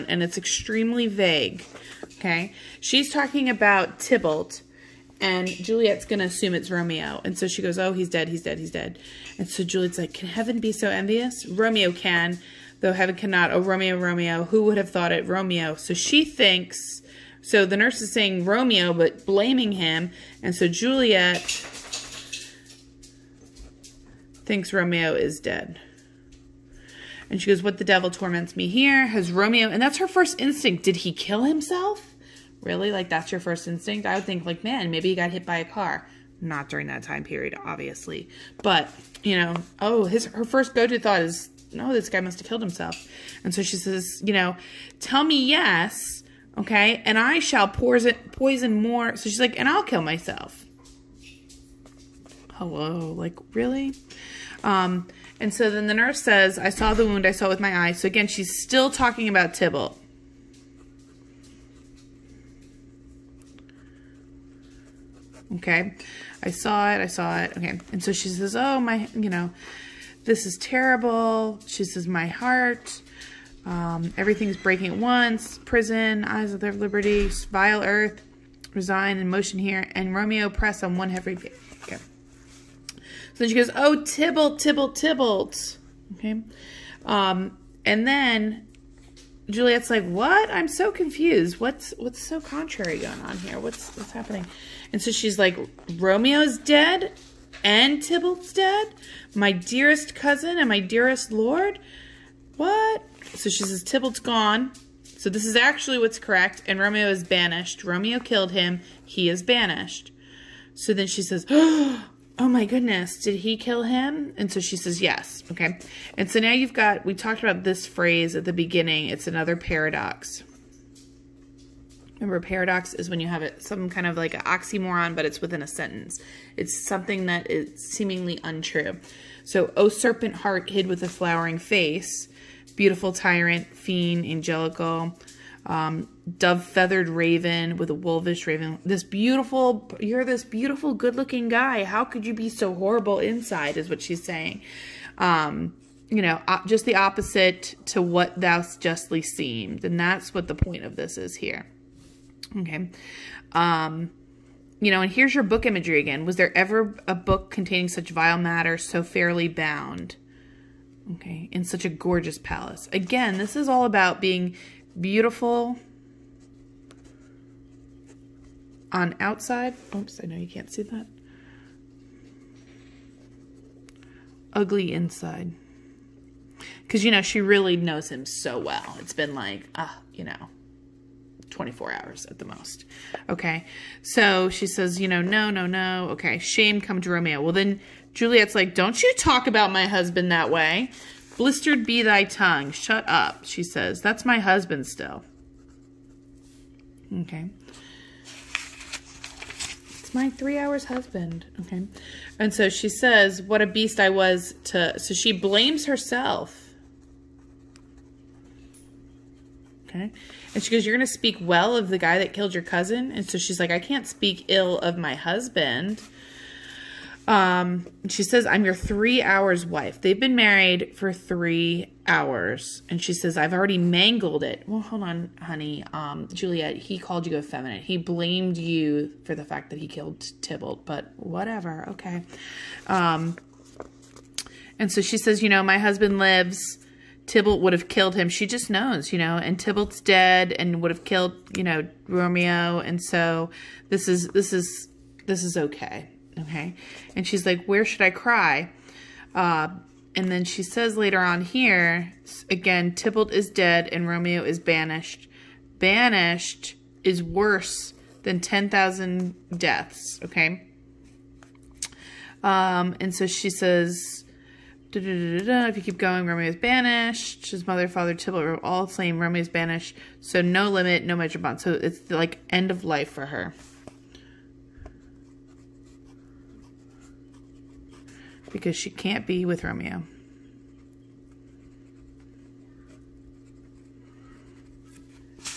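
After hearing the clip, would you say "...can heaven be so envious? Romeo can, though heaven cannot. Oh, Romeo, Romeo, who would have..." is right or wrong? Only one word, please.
right.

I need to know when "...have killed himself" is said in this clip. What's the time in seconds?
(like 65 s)
42 s.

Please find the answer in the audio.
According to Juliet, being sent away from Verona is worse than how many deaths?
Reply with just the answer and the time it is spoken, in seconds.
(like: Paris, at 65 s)
10,000, at 258 s.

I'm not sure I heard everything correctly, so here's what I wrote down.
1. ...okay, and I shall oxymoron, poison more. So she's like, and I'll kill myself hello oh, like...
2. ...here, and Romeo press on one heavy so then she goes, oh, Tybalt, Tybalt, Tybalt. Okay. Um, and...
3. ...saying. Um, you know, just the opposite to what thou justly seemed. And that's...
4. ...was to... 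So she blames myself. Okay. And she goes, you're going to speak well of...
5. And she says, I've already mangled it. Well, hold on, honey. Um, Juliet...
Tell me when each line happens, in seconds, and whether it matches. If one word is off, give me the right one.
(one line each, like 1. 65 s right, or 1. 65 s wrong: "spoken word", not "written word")
1. 46 s wrong: "poison", not "oxymoron"
2. 79 s right
3. 144 s right
4. 204 s wrong: "herself", not "myself"
5. 222 s right.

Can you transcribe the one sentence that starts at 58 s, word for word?
So again, she's still talking about Tybalt.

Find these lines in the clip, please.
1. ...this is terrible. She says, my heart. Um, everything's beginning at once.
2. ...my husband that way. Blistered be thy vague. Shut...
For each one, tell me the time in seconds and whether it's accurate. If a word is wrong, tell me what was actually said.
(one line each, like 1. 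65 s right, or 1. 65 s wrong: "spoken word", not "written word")
1. 70 s wrong: "breaking", not "beginning"
2. 189 s wrong: "tongue", not "vague".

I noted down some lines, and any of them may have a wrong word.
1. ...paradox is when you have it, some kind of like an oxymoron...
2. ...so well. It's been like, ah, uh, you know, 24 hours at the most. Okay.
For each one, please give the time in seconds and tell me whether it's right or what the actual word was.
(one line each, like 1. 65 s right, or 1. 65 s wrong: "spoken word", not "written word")
1. 122 s right
2. 178 s right.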